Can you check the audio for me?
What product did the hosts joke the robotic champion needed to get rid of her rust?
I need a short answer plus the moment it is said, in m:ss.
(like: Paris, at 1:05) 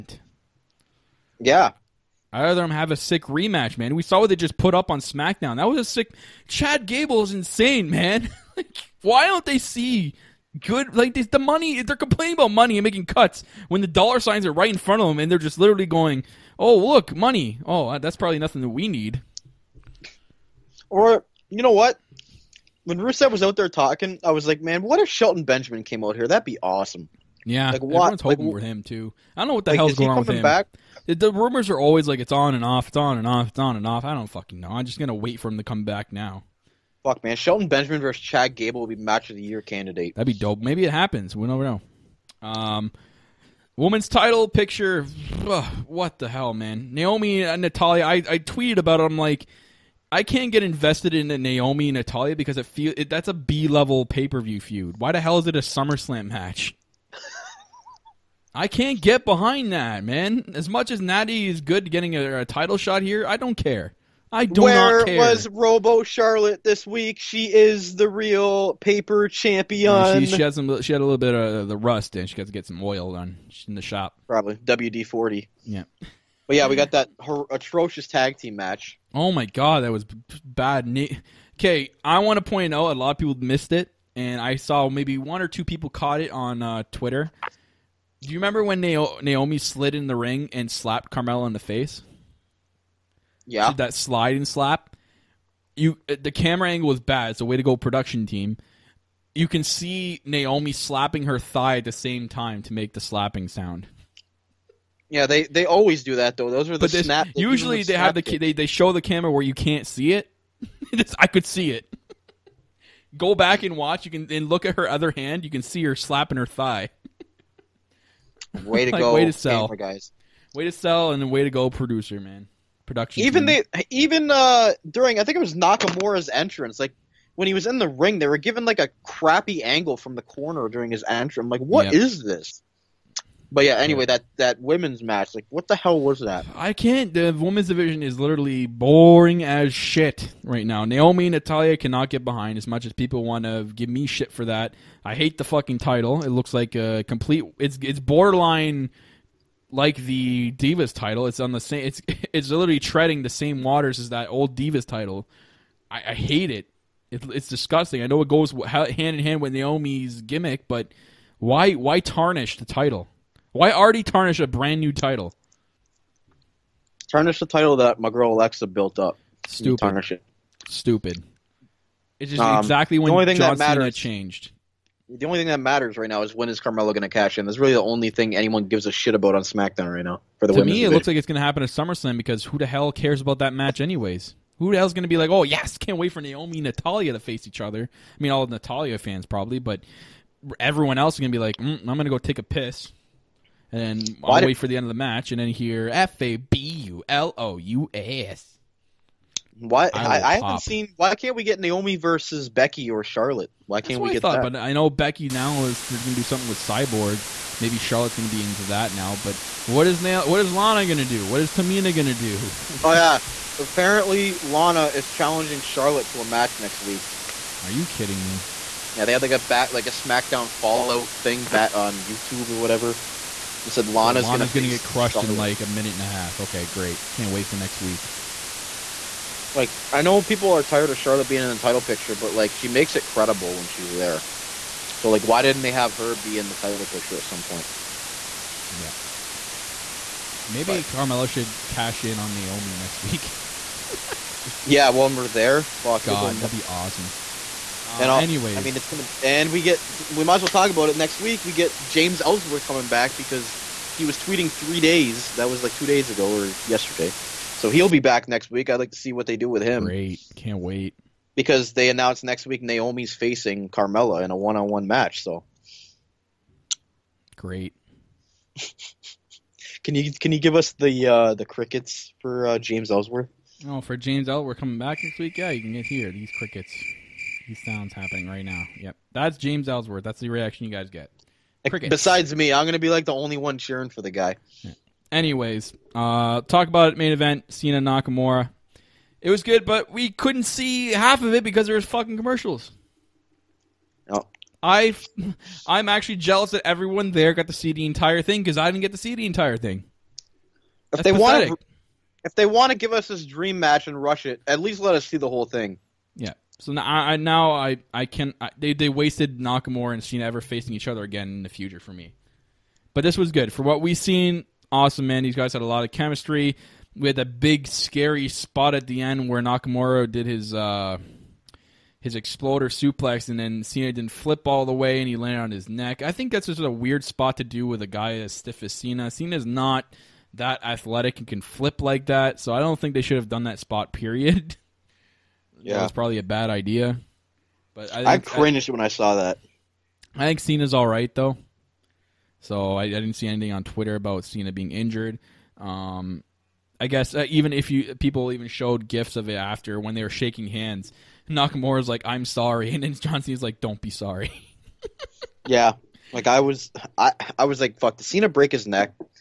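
WD forty, at 1:14.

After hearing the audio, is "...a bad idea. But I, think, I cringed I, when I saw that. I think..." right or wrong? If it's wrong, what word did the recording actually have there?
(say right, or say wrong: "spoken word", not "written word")
right.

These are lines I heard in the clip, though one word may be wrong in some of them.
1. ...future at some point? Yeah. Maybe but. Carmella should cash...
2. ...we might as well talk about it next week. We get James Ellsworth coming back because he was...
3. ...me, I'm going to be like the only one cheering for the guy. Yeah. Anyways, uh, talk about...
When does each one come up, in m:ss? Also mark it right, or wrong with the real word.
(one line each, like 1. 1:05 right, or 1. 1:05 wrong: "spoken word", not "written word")
1. 3:56 wrong: "picture", not "future"
2. 4:10 right
3. 4:42 right.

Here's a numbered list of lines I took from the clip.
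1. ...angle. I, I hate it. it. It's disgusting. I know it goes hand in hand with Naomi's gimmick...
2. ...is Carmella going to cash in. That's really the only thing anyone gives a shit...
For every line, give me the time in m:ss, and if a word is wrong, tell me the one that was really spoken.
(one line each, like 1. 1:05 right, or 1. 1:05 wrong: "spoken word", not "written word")
1. 2:34 wrong: "title", not "angle"
2. 2:56 right.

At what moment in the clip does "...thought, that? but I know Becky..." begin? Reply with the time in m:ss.
3:24.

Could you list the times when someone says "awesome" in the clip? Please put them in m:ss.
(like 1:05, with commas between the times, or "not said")
0:26, 4:06, 5:14.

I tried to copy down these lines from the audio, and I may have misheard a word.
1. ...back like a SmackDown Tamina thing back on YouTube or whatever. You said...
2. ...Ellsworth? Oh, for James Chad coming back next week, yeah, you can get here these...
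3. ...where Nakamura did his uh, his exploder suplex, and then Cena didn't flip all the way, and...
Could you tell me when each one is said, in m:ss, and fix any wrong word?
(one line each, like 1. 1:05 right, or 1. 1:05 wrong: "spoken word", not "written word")
1. 3:39 wrong: "Fallout", not "Tamina"
2. 4:32 wrong: "Ellsworth", not "Chad"
3. 5:19 right.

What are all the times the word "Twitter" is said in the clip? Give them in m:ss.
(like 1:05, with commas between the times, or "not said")
1:26, 5:43.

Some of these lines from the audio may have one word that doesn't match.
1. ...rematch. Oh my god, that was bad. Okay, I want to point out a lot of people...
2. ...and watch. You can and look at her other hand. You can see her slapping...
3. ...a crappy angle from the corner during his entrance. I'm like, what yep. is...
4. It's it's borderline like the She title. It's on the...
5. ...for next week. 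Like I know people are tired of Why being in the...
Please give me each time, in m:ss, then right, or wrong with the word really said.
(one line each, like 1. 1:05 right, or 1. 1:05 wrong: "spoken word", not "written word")
1. 1:18 wrong: "match", not "rematch"
2. 1:53 right
3. 2:08 right
4. 2:27 wrong: "Divas", not "She"
5. 3:47 wrong: "Charlotte", not "Why".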